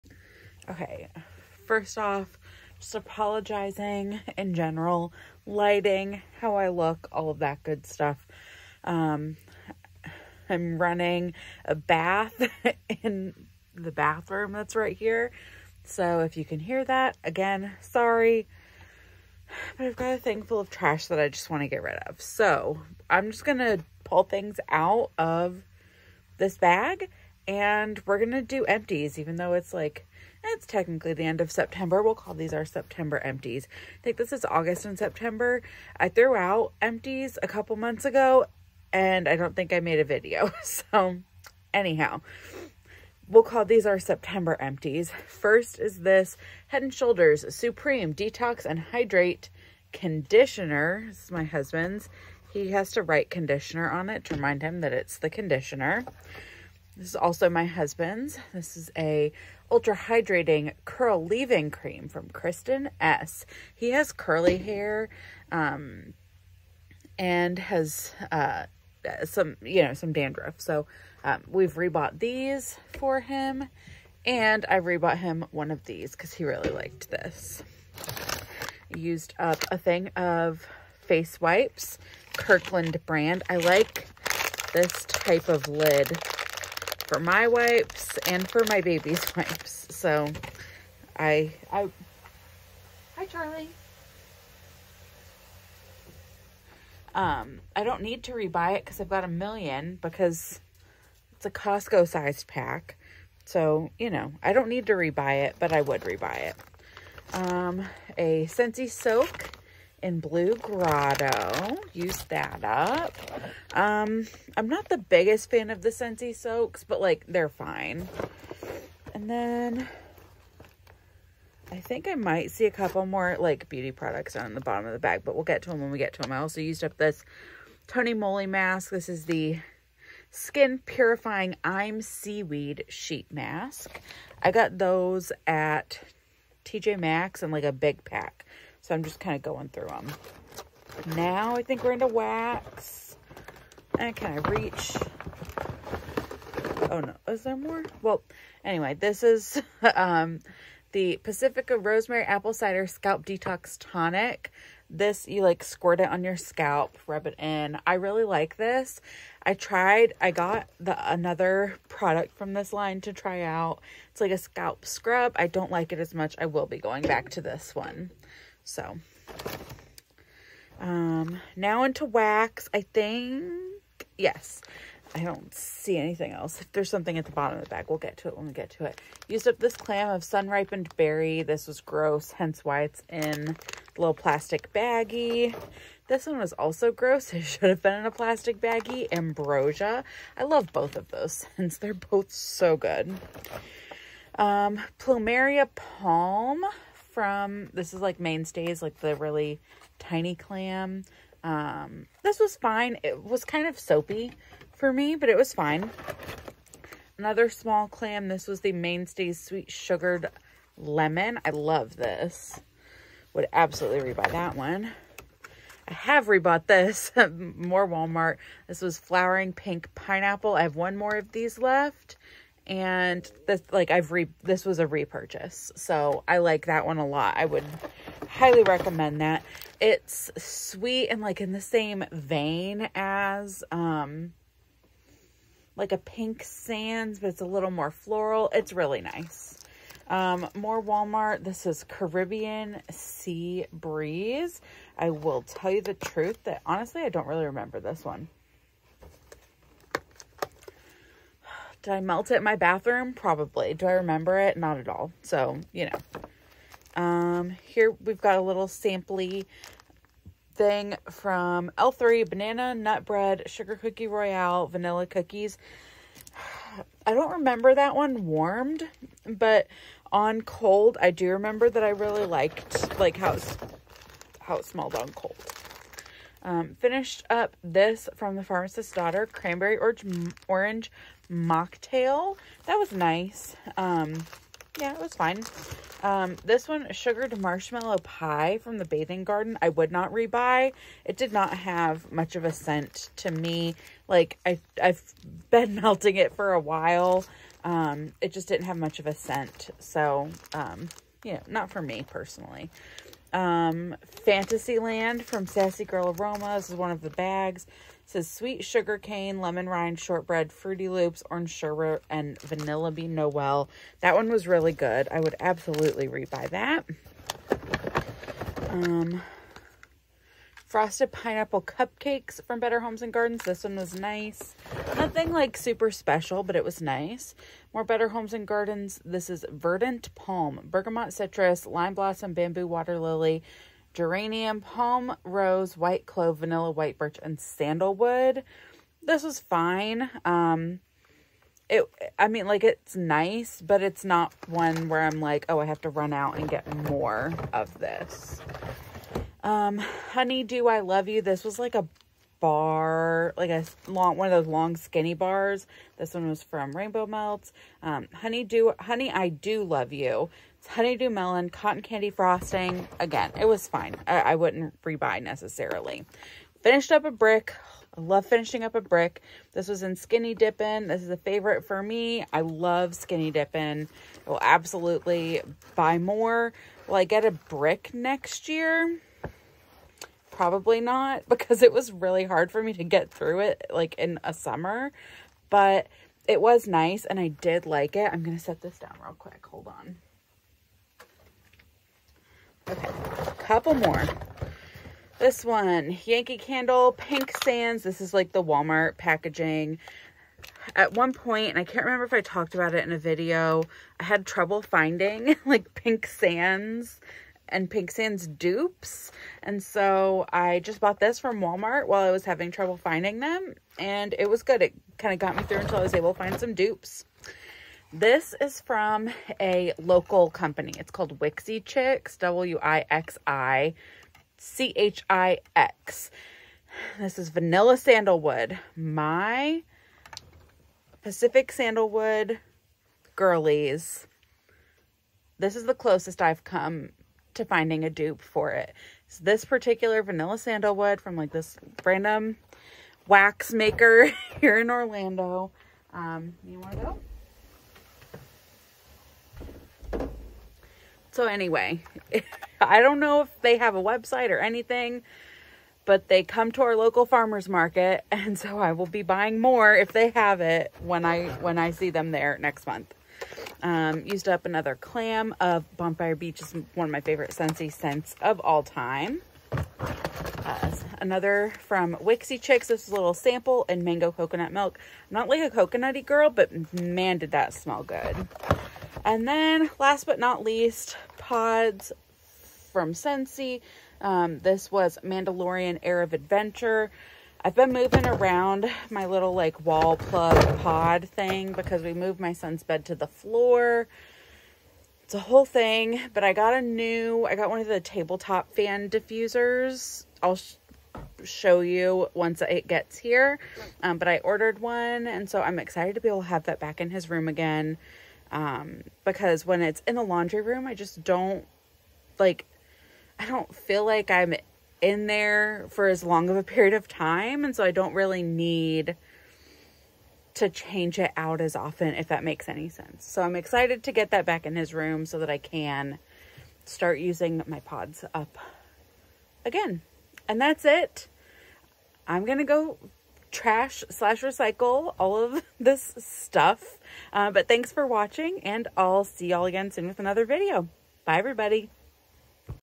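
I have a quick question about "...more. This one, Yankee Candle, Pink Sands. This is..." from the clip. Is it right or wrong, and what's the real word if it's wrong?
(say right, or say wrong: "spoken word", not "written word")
right.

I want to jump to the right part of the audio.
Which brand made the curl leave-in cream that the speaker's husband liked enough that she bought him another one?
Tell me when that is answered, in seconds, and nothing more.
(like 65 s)
62 s.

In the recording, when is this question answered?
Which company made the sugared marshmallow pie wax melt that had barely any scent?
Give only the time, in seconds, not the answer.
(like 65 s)
288 s.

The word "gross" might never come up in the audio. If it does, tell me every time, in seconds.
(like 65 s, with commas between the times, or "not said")
181 s, 186 s.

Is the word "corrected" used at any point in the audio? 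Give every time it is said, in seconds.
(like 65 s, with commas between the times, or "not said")
not said.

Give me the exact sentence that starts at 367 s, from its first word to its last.
I love finishing up a brick.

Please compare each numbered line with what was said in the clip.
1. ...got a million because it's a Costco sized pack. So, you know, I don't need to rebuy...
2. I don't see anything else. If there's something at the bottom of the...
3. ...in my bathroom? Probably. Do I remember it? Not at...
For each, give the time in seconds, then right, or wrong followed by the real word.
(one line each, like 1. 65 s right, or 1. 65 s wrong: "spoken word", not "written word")
1. 99 s right
2. 175 s right
3. 252 s right.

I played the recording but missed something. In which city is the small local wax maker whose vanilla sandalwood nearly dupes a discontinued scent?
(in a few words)
Orlando.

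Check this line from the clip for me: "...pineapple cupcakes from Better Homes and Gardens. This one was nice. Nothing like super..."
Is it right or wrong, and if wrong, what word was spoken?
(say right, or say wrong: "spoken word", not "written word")
right.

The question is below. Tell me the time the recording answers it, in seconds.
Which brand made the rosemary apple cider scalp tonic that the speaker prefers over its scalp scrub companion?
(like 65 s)
151 s.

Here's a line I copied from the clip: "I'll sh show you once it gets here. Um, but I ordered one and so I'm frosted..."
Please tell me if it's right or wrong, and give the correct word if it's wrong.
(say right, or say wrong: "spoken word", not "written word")
wrong: "excited", not "frosted".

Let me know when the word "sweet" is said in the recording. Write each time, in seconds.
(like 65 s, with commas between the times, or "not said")
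209 s, 230 s, 308 s.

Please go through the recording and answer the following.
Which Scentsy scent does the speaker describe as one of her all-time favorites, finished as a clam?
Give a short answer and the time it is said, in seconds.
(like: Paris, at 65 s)
Bonfire Beach, at 465 s.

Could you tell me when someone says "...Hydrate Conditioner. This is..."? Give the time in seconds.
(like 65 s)
48 s.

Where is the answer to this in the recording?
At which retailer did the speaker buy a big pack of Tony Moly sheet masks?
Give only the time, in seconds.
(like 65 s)
136 s.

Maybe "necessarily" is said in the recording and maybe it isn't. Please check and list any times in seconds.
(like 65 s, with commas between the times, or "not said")
365 s.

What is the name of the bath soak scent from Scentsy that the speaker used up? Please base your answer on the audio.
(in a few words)
Blue Grotto.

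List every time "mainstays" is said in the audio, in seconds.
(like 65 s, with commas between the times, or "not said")
198 s, 208 s.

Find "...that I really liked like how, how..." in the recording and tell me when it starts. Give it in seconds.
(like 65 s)
271 s.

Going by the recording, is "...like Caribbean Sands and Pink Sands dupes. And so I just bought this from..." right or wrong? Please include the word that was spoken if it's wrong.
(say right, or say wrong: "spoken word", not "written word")
wrong: "Pink", not "Caribbean".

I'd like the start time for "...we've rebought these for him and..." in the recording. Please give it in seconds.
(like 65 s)
71 s.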